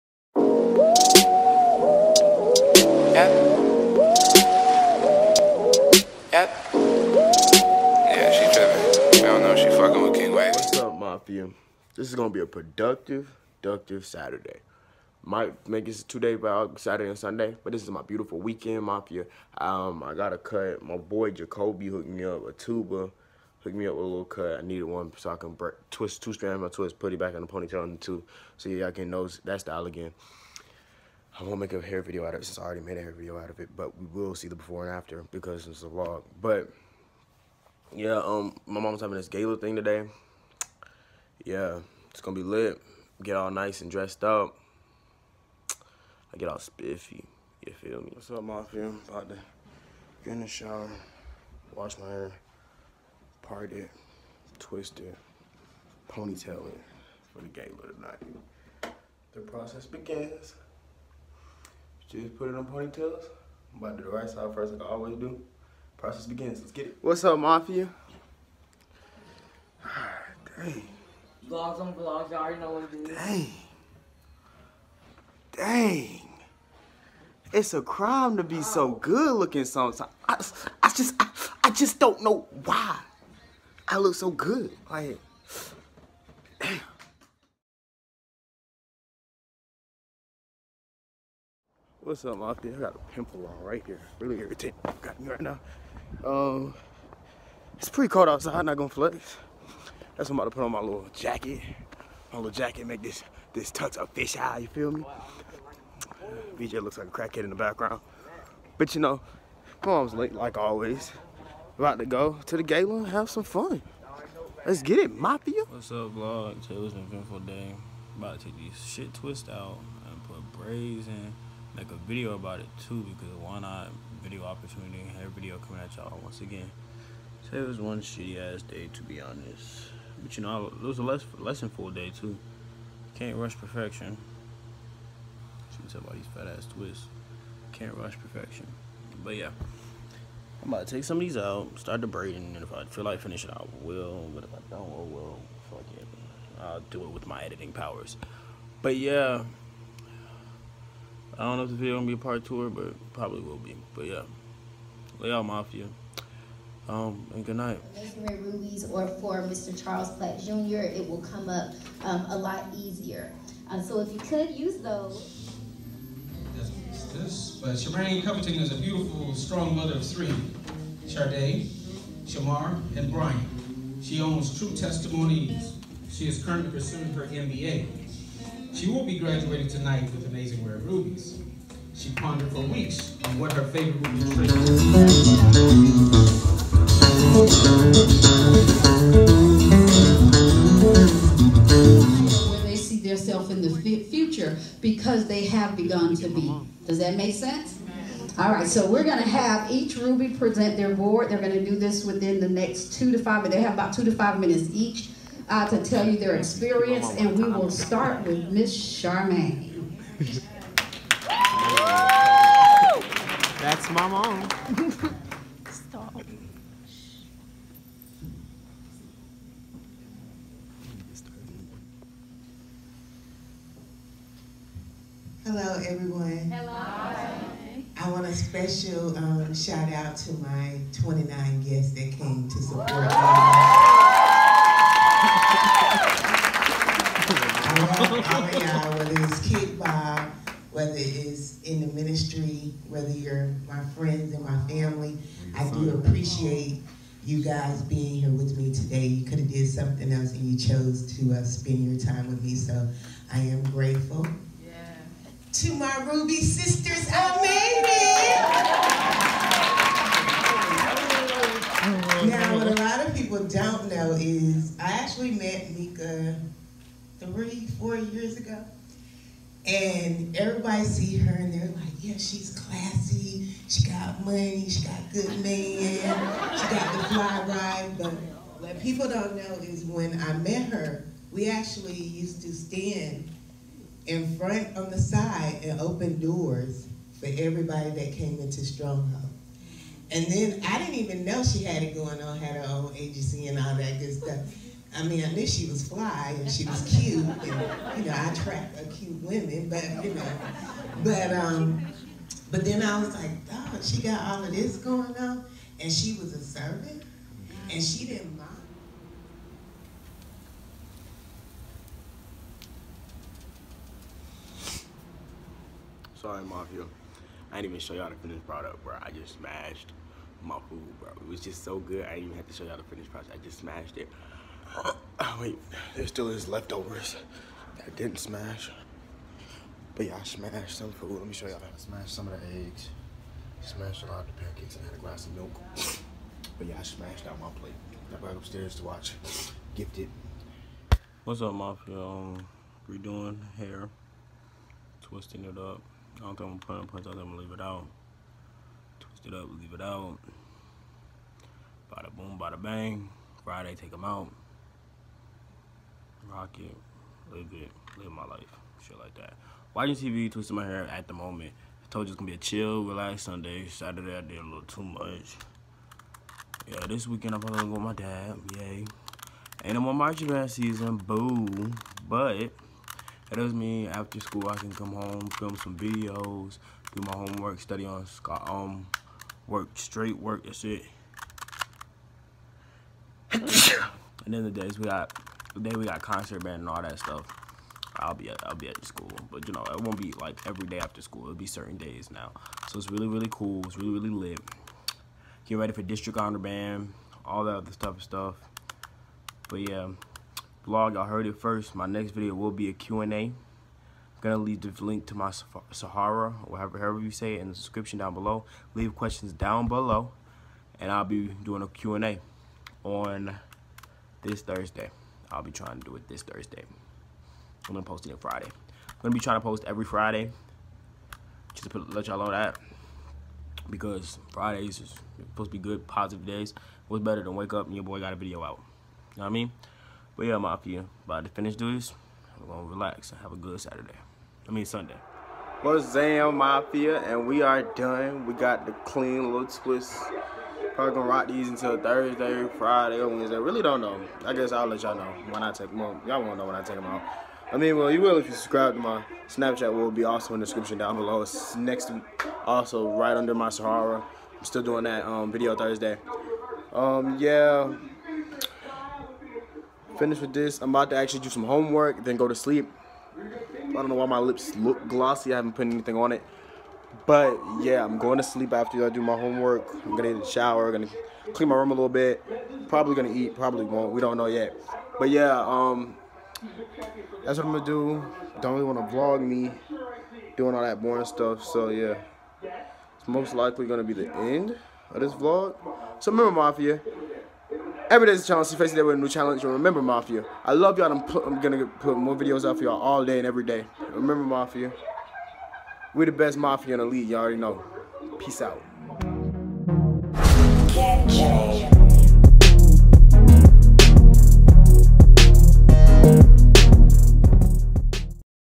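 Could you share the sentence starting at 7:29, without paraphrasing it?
Will be also in the description down below.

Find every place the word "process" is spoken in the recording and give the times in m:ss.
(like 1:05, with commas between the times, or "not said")
0:59, 1:05.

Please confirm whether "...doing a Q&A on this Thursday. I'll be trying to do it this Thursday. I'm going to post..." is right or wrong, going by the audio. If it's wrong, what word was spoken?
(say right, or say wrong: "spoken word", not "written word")
right.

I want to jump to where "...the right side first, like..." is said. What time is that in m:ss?
1:04.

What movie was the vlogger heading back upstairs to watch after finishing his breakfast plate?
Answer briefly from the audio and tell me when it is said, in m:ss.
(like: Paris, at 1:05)
Gifted, at 5:39.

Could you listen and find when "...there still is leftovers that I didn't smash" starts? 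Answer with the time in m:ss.
5:25.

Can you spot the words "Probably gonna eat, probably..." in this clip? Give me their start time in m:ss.
7:52.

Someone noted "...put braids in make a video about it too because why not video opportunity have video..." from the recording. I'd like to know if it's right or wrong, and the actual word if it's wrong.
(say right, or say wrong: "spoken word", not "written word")
right.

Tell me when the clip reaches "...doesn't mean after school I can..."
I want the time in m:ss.
6:13.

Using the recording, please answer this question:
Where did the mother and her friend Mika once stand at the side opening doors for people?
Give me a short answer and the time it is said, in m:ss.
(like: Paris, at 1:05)
Stronghold, at 4:48.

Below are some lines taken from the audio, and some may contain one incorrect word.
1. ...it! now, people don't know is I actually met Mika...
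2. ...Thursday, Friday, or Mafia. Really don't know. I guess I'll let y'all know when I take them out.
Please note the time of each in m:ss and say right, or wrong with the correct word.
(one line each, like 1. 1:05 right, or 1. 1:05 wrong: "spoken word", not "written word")
1. 4:22 right
2. 7:21 wrong: "Wednesday", not "Mafia".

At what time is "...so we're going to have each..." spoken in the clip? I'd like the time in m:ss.
3:18.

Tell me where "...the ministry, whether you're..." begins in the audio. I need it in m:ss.
4:01.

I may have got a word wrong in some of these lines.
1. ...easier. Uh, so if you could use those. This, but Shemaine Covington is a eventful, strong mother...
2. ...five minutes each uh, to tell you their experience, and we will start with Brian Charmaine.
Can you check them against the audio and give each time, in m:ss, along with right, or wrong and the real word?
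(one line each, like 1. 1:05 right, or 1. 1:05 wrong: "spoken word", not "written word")
1. 2:42 wrong: "beautiful", not "eventful"
2. 3:24 wrong: "Miss", not "Brian".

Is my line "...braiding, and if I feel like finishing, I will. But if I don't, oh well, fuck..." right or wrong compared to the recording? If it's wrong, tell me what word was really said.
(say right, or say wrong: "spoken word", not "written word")
right.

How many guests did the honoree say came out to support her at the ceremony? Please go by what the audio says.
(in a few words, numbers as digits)
29.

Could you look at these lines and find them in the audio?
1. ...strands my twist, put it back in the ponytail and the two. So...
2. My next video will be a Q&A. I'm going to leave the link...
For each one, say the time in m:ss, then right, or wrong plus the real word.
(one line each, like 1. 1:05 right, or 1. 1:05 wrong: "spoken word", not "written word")
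1. 0:26 right
2. 6:41 right.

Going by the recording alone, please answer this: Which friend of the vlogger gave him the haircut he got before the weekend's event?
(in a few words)
Jacoby.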